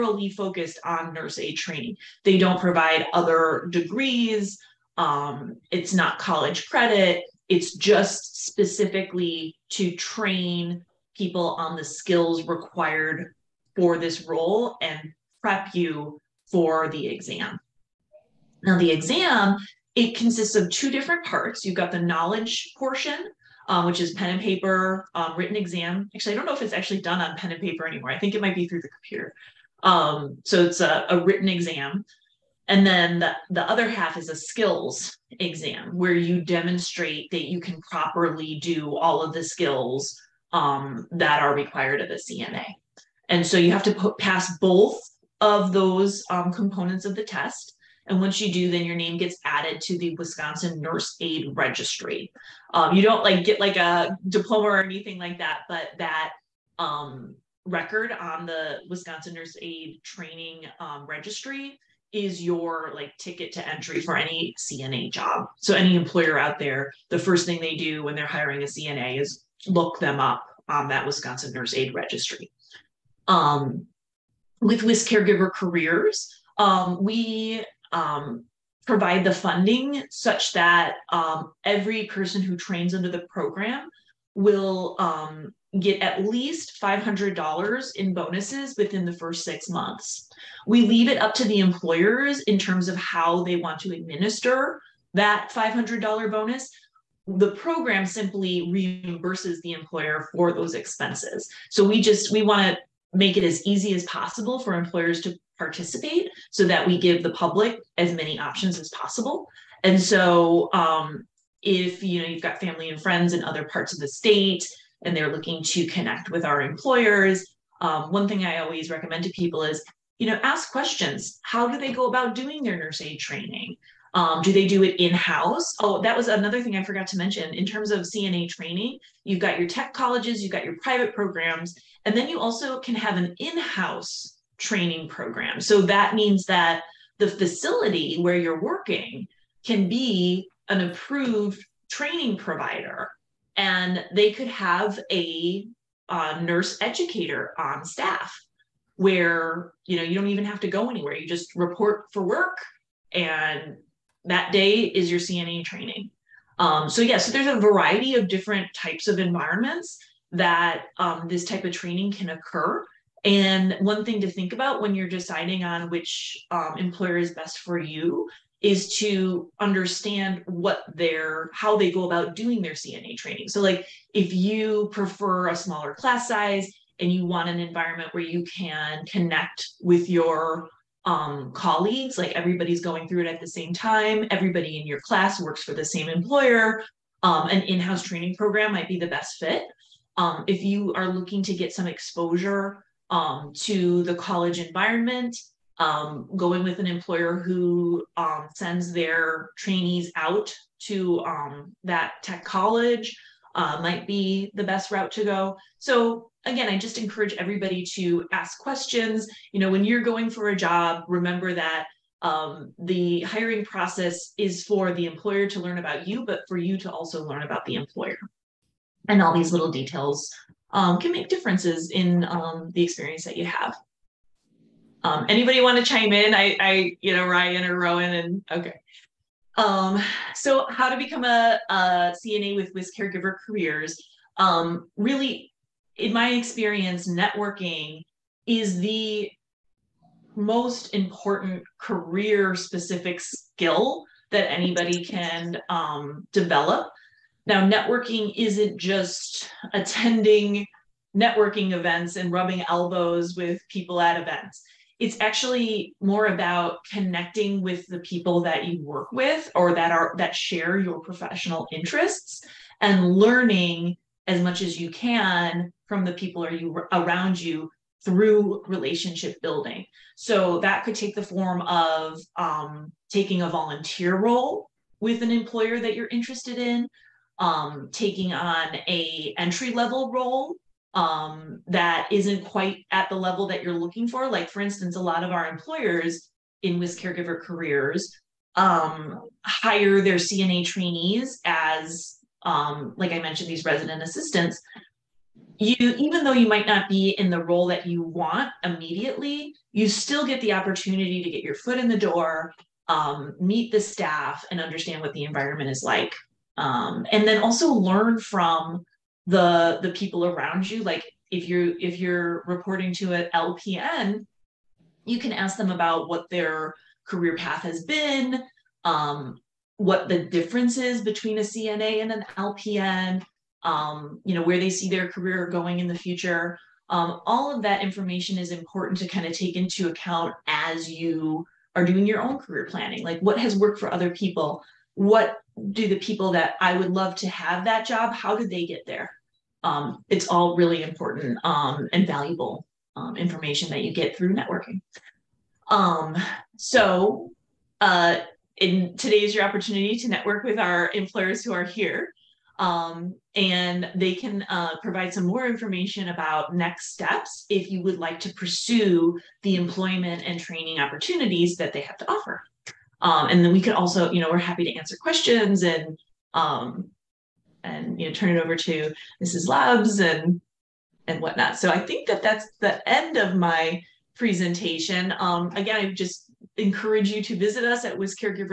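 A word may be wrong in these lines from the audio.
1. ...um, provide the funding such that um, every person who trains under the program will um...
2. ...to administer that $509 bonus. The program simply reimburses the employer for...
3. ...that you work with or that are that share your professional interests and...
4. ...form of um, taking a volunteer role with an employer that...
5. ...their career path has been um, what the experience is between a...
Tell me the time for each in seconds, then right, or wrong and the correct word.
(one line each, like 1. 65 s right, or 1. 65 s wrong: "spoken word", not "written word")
1. 77 s right
2. 93 s wrong: "500", not "509"
3. 258 s right
4. 271 s right
5. 316 s wrong: "difference", not "experience".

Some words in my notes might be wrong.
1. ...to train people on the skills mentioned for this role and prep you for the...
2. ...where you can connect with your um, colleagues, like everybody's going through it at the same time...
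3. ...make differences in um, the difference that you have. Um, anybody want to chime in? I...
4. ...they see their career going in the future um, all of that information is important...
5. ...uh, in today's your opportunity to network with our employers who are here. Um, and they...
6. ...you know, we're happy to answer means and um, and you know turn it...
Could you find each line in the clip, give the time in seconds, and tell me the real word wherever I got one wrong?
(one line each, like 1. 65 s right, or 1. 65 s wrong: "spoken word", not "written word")
1. 9 s wrong: "required", not "mentioned"
2. 178 s right
3. 221 s wrong: "experience", not "difference"
4. 324 s right
5. 347 s right
6. 364 s wrong: "questions", not "means".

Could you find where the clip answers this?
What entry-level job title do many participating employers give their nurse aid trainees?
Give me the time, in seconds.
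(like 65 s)
293 s.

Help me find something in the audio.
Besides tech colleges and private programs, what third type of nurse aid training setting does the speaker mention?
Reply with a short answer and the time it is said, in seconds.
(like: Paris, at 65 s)
in house training program, at 133 s.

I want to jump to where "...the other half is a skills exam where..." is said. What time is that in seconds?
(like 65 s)
33 s.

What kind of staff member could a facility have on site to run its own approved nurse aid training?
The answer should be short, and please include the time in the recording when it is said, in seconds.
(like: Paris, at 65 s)
nurse educator, at 146 s.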